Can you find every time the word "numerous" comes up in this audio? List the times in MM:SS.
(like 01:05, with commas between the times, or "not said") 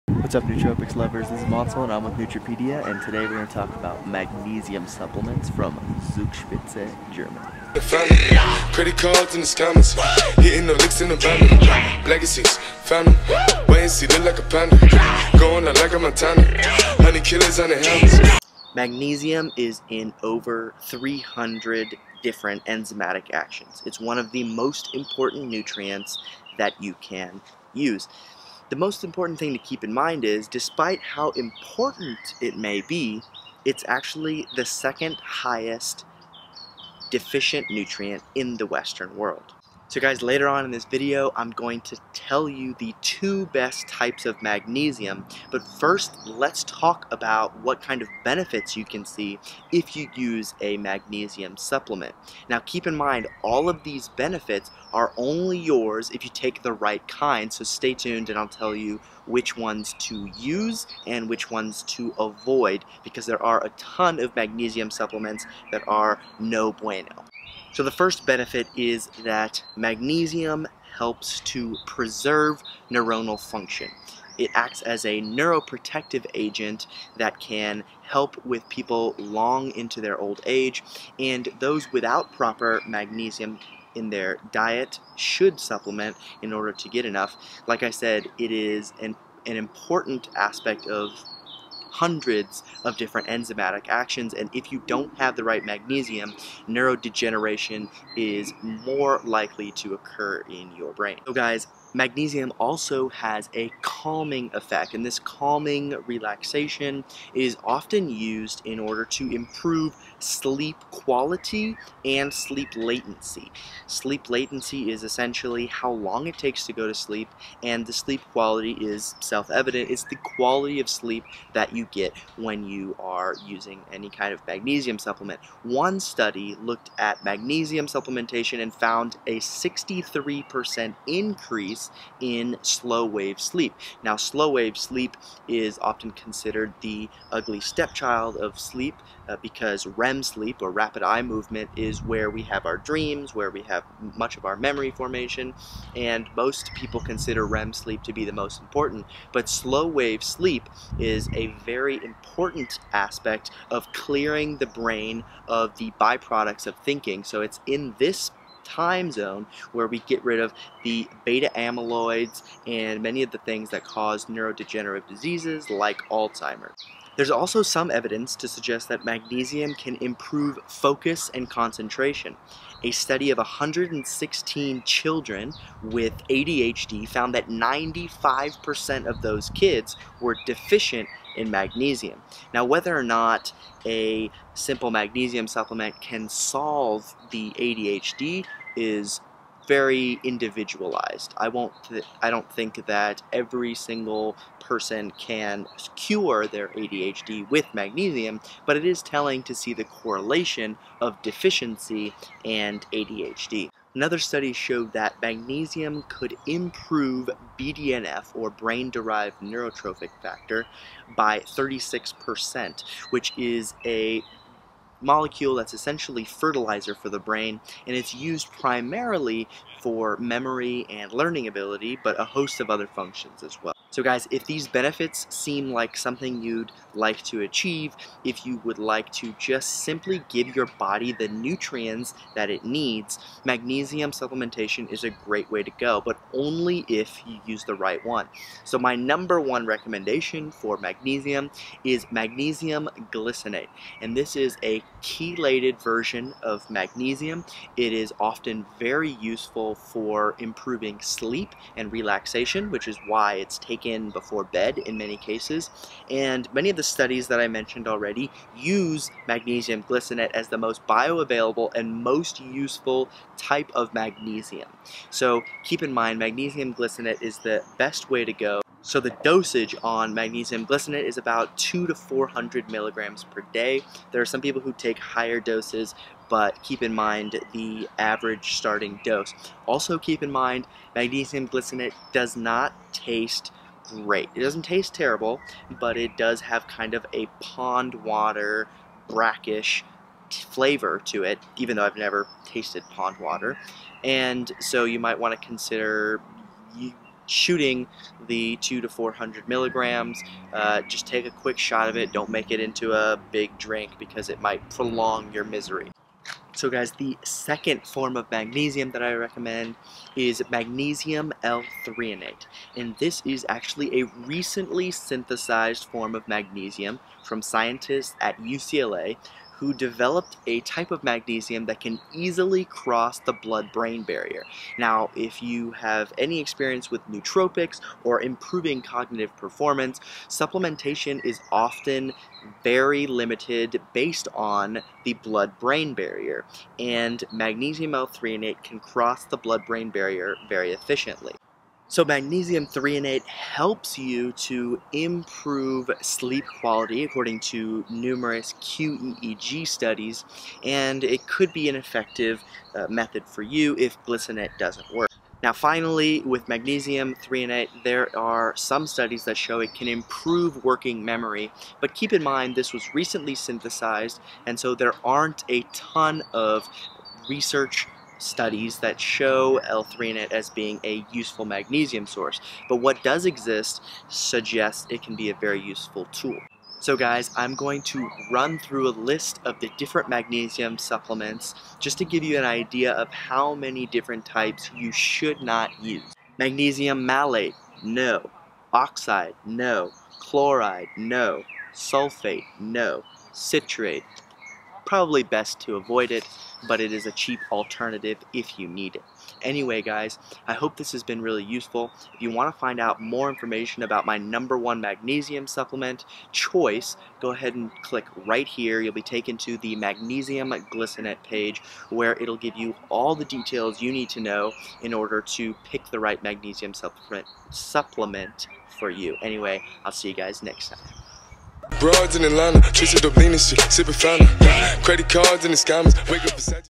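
05:47.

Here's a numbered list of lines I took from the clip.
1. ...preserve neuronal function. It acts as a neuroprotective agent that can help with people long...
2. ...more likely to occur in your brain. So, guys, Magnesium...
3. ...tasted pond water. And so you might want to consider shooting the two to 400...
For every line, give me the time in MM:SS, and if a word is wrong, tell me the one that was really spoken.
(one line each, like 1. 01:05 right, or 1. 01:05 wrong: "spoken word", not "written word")
1. 01:11 right
2. 01:38 right
3. 04:52 right.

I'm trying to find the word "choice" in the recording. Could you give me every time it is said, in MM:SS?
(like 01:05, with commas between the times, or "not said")
06:46.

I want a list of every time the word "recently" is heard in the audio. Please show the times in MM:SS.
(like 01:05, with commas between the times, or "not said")
05:14, 06:02.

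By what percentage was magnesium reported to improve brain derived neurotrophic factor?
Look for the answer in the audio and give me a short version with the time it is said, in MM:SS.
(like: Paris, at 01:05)
36%, at 03:31.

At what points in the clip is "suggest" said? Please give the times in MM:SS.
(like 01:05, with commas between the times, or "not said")
02:48, 06:14.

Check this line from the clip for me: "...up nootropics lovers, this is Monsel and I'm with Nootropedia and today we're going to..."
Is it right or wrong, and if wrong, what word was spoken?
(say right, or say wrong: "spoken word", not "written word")
right.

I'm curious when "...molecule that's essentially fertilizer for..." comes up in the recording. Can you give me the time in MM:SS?
03:35.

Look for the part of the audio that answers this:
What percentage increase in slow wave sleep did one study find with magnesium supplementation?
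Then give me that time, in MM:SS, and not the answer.
02:09.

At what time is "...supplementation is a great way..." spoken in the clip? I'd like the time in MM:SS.
03:54.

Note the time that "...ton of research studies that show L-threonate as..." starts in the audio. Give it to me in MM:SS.
06:05.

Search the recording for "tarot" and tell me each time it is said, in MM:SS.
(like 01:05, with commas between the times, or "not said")
not said.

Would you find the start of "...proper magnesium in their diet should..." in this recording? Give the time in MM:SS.
01:22.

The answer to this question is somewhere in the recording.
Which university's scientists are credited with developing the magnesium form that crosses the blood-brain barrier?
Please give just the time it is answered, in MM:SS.
05:18.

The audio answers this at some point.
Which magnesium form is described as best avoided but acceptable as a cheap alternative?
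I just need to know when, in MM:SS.
06:33.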